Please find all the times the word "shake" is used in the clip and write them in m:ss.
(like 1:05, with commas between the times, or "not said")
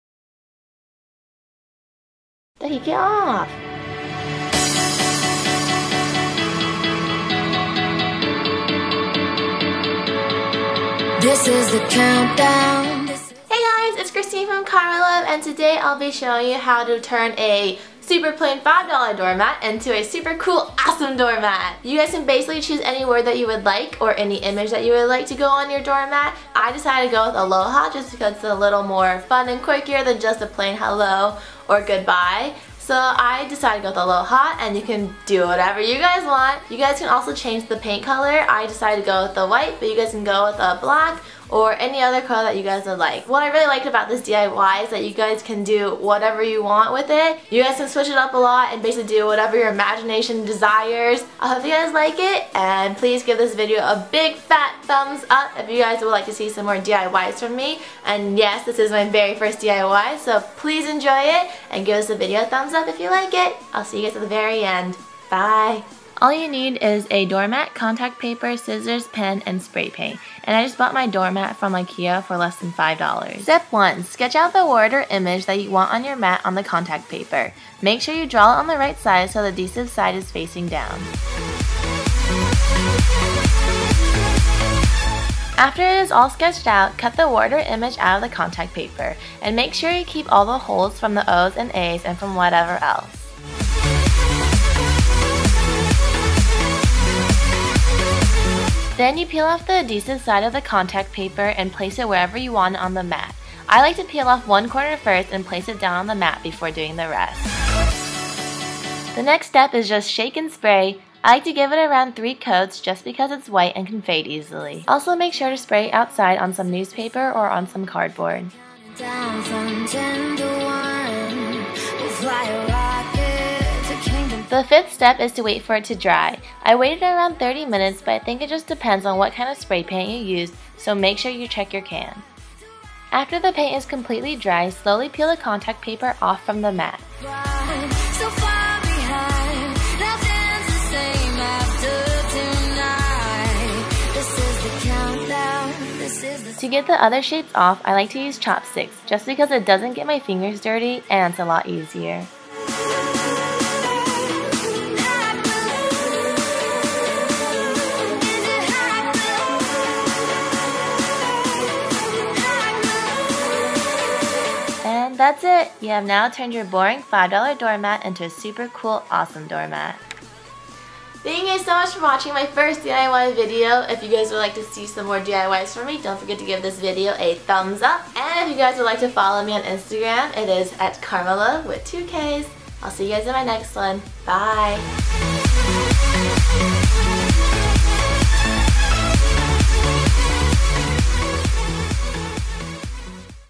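1:50.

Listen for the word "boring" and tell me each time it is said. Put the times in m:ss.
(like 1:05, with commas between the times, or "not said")
2:46.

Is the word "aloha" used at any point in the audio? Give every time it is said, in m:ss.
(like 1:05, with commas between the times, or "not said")
0:27, 0:33.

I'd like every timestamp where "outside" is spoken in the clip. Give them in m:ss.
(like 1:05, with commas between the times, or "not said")
1:55.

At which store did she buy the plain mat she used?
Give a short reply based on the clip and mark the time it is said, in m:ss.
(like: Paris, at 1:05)
Ikea, at 1:11.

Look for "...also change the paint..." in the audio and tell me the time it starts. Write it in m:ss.
0:37.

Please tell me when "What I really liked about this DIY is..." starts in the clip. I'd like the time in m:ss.
0:43.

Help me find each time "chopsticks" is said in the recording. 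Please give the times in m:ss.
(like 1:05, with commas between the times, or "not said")
2:28.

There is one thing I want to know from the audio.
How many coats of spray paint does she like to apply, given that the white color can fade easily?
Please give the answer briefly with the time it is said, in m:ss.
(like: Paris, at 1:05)
3, at 1:52.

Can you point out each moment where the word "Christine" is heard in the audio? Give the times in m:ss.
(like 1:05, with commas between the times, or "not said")
0:14.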